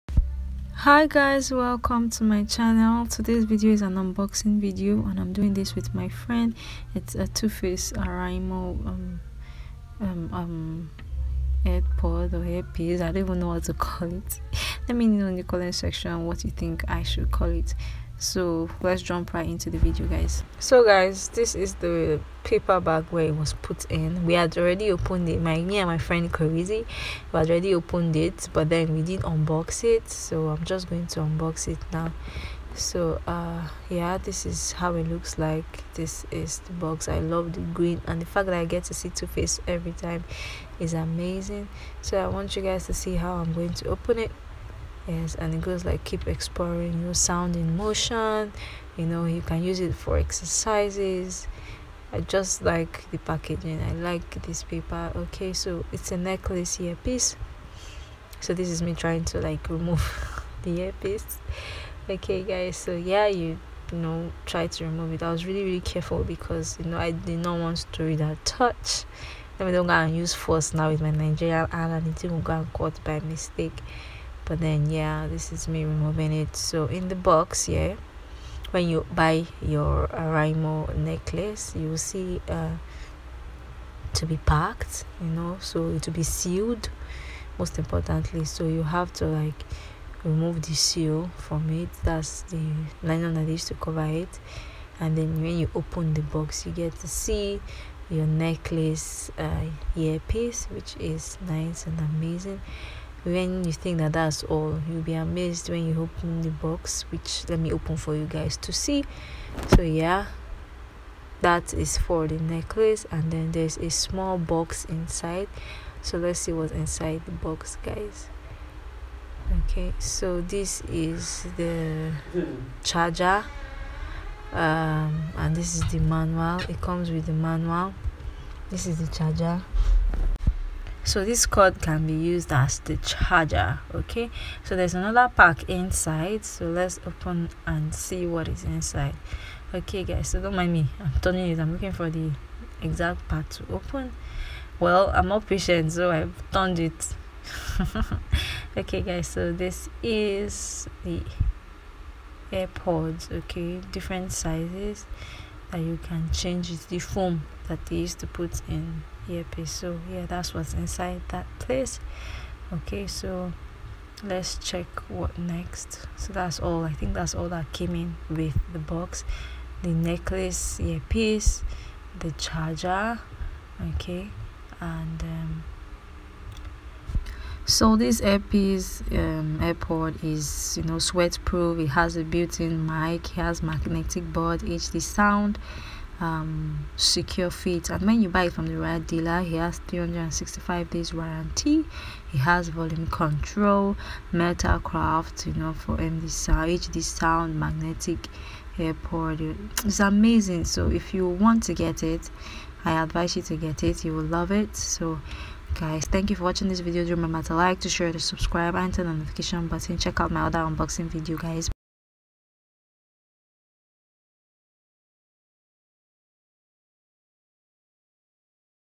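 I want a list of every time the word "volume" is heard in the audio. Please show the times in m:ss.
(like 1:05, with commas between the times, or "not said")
3:12.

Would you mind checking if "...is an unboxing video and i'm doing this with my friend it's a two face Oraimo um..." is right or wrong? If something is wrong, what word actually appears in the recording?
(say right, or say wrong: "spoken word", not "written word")
right.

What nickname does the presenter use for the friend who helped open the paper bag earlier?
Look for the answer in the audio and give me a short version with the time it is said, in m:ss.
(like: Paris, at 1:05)
crazy, at 0:26.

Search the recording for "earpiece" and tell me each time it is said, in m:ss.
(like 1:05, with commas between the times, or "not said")
0:12, 0:56, 1:00, 1:39, 2:39, 2:50, 2:58.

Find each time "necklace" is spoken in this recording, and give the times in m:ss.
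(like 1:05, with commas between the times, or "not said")
0:56, 1:20, 1:38, 1:52, 2:49.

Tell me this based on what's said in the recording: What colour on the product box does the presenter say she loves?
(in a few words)
green.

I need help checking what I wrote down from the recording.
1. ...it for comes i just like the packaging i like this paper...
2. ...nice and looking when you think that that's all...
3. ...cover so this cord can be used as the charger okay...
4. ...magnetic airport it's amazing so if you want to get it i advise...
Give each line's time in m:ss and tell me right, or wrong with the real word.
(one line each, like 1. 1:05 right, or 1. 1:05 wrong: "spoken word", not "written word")
1. 0:49 wrong: "exercises", not "comes"
2. 1:41 wrong: "amazing", not "looking"
3. 2:09 wrong: "charger", not "cover"
4. 3:17 right.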